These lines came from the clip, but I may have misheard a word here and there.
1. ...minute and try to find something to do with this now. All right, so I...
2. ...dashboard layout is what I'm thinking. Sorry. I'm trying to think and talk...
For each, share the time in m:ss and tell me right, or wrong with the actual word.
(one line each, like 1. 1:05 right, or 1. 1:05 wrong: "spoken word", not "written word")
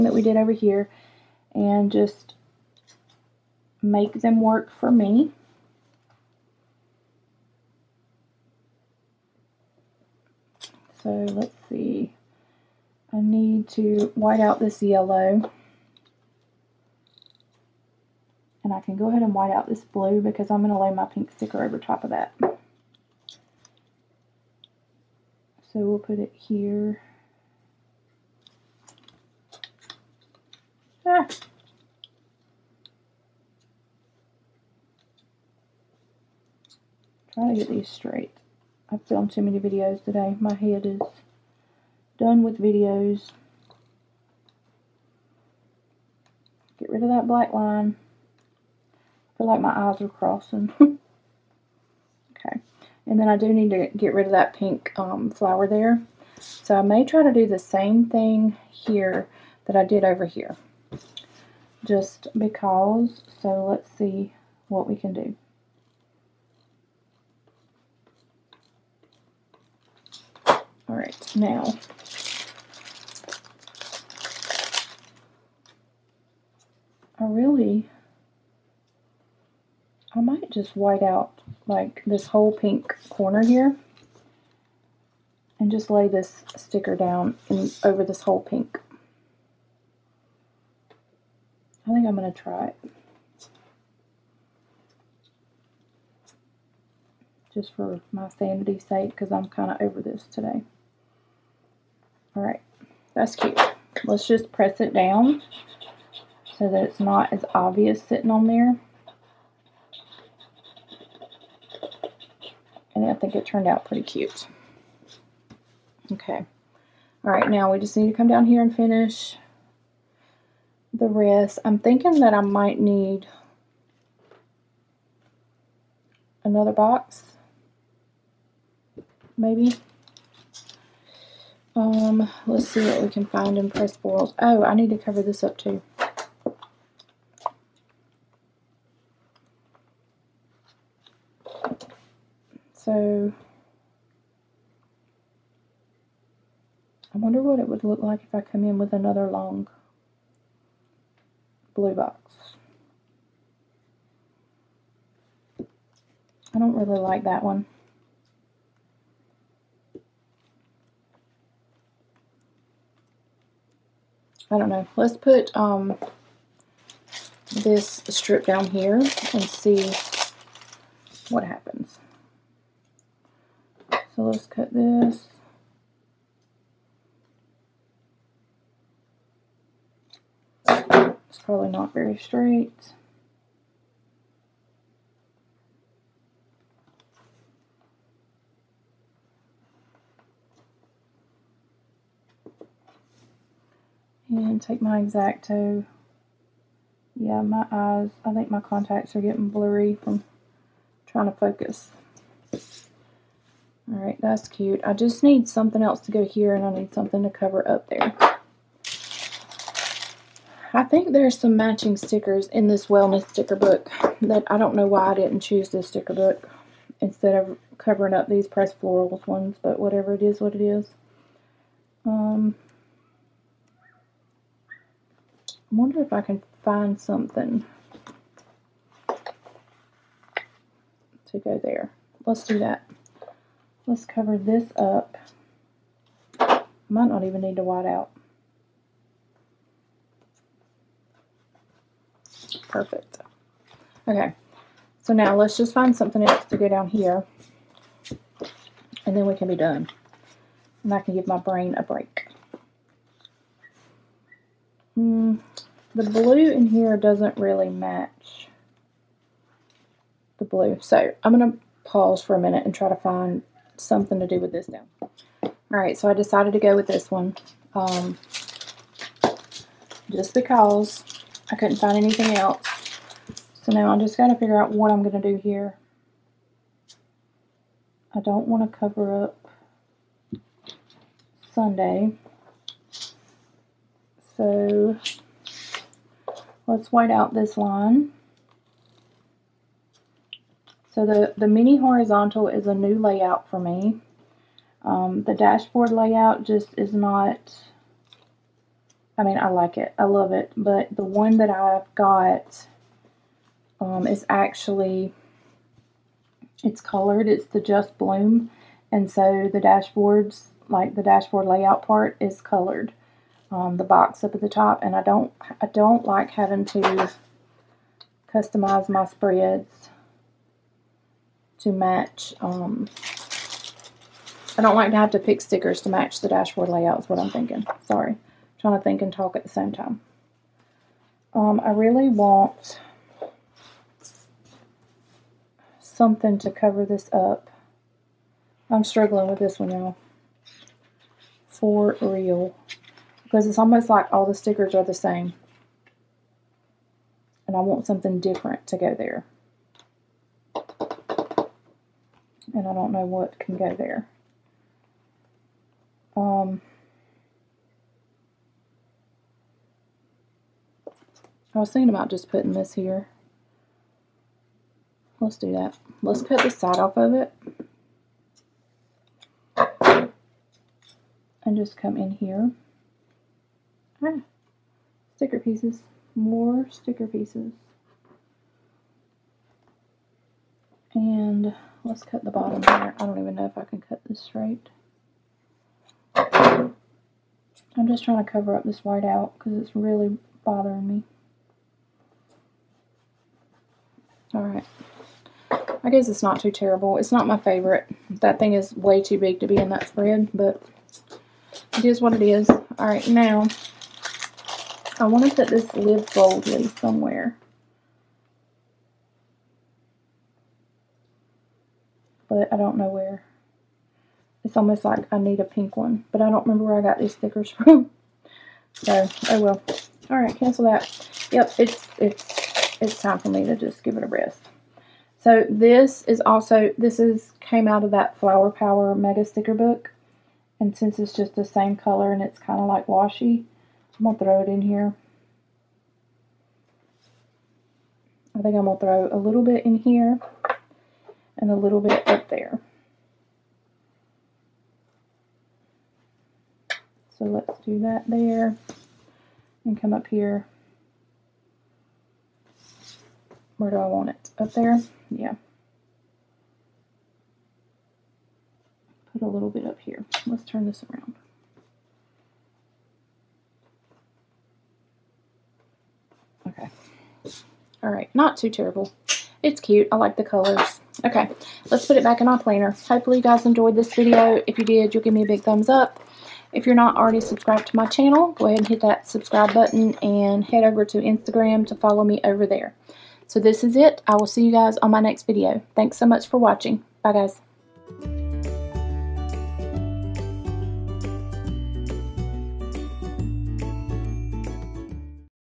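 1. 4:22 right
2. 5:26 right.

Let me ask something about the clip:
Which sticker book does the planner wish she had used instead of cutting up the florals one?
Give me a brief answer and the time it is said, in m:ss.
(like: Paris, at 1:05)
wellness sticker book, at 3:32.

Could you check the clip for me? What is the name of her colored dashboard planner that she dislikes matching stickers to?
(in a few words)
Just Bloom.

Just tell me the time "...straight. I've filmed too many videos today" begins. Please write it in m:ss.
0:37.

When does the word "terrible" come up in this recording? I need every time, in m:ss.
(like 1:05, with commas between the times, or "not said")
6:36, 7:48.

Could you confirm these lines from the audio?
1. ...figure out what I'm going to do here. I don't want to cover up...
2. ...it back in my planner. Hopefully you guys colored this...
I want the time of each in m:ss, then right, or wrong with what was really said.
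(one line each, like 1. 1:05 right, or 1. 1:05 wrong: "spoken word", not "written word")
1. 4:34 right
2. 7:51 wrong: "enjoyed", not "colored".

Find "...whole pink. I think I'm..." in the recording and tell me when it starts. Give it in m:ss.
1:28.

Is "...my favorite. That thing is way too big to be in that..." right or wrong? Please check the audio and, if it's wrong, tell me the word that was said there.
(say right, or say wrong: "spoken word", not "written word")
right.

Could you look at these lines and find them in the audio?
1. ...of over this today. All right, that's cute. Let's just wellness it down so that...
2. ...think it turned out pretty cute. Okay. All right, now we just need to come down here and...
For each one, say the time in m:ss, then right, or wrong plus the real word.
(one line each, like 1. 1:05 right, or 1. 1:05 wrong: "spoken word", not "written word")
1. 1:39 wrong: "press", not "wellness"
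2. 1:53 right.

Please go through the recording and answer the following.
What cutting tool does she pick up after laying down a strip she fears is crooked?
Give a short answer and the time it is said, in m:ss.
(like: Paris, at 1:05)
Exacto, at 3:15.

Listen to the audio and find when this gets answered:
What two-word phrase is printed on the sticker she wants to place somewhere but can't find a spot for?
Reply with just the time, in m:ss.
6:45.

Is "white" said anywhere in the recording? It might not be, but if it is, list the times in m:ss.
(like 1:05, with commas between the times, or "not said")
0:14, 0:19, 1:20, 3:57, 4:46, 6:28.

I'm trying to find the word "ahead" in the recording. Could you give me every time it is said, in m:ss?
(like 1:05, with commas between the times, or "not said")
0:19, 7:58.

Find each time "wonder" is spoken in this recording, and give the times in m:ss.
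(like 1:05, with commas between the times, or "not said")
2:27, 3:45.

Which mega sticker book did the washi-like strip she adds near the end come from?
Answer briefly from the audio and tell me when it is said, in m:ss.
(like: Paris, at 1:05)
Flower Power Mega Sticker Book, at 7:08.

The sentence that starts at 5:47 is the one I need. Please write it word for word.
And I want something different to go there.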